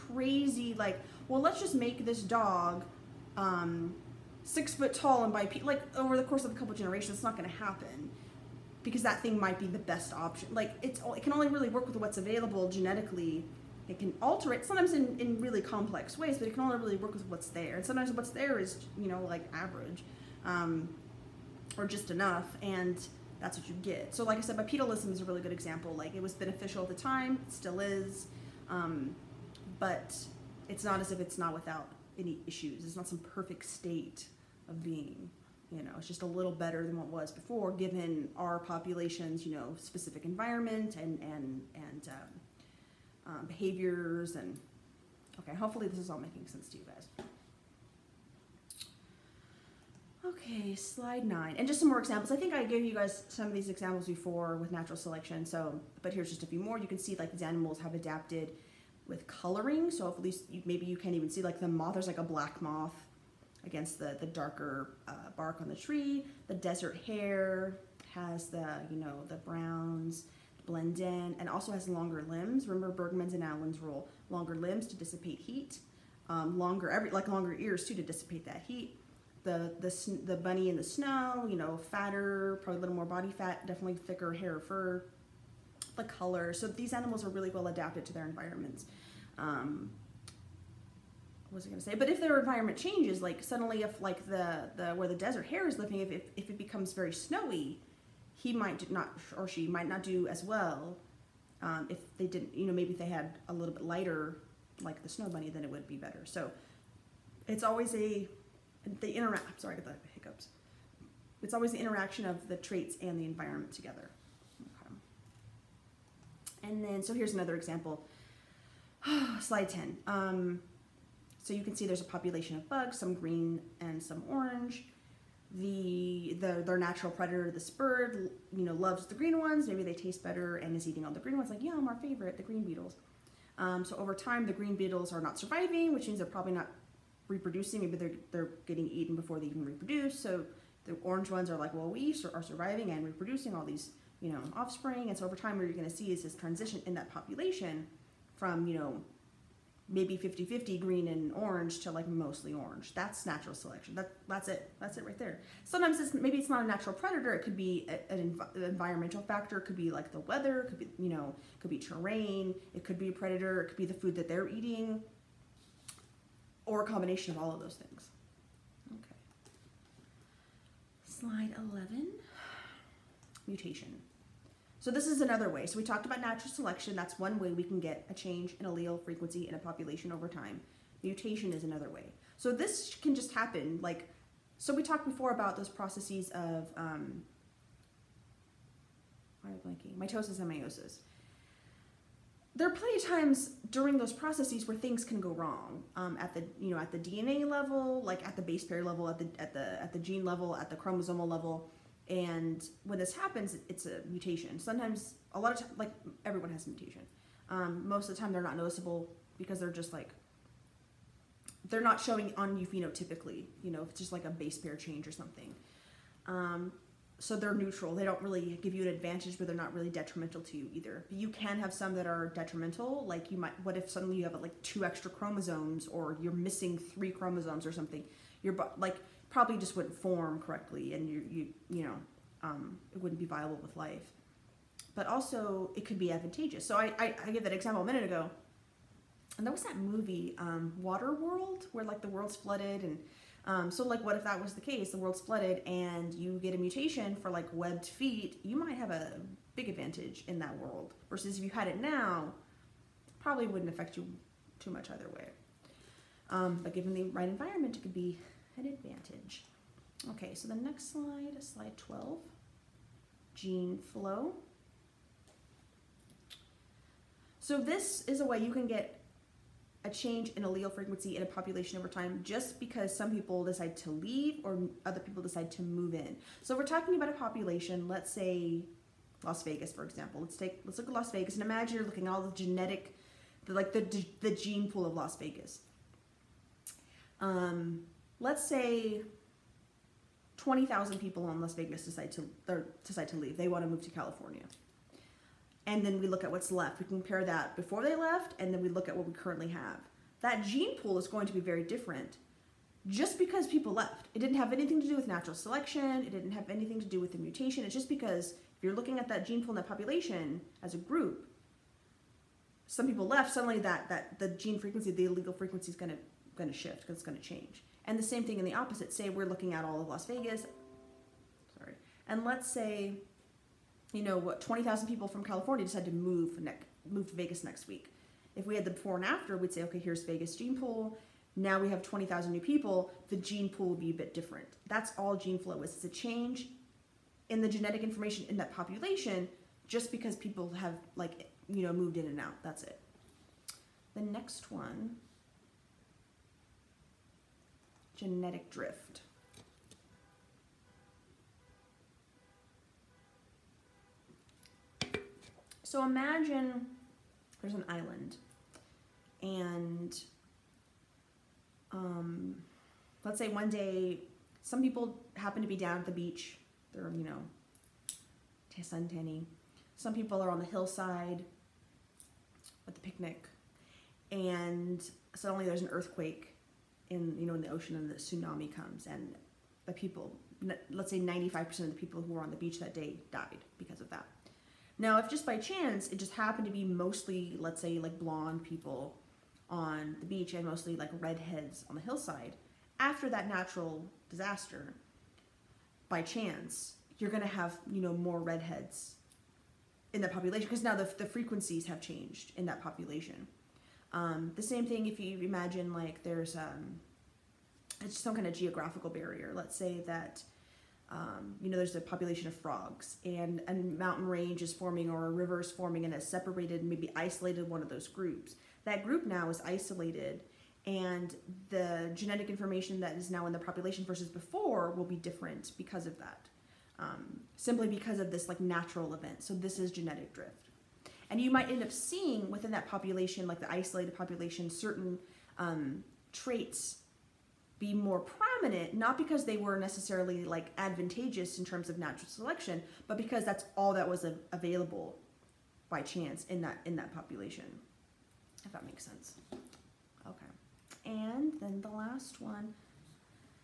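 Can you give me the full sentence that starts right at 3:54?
But also it could be advantageous.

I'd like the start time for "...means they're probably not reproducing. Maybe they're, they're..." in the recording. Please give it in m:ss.
2:16.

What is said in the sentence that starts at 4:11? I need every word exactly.
Versus if you had it now, probably wouldn't affect you too much either way.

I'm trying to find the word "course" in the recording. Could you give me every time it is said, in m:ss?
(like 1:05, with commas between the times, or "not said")
0:06.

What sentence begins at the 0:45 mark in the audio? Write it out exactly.
Okay, hopefully this is all making sense to you guys.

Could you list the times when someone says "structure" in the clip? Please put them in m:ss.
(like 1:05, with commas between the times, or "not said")
not said.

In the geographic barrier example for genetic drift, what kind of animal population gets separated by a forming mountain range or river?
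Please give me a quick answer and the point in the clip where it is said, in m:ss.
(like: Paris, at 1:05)
frogs, at 6:52.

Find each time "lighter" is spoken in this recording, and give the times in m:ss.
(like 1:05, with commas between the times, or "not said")
1:43.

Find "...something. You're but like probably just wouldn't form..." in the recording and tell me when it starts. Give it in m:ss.
3:47.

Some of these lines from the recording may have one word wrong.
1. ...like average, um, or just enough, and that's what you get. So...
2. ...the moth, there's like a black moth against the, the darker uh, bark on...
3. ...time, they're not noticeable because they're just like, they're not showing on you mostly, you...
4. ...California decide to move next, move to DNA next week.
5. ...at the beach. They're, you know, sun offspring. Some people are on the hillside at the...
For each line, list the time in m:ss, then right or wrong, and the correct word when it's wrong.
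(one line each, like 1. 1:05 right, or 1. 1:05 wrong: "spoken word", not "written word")
1. 0:19 right
2. 1:01 right
3. 3:28 wrong: "phenotypically", not "mostly"
4. 5:25 wrong: "Vegas", not "DNA"
5. 6:05 wrong: "tanning", not "offspring".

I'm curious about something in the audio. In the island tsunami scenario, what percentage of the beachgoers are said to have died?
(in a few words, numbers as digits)
95%.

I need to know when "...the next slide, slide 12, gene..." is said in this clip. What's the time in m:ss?
4:20.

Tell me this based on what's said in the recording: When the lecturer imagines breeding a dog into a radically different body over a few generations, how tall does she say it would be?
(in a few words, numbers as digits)
6 foot.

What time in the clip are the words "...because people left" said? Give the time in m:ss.
5:03.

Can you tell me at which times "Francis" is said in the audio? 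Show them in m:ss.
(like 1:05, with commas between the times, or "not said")
not said.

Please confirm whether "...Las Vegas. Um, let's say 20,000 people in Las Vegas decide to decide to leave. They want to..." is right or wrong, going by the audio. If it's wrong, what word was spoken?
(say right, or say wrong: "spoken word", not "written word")
right.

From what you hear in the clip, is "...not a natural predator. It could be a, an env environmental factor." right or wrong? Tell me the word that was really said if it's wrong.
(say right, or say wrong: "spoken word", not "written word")
right.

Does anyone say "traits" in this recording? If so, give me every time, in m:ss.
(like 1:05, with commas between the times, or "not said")
1:52, 7:16.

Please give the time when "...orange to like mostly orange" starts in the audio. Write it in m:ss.
2:31.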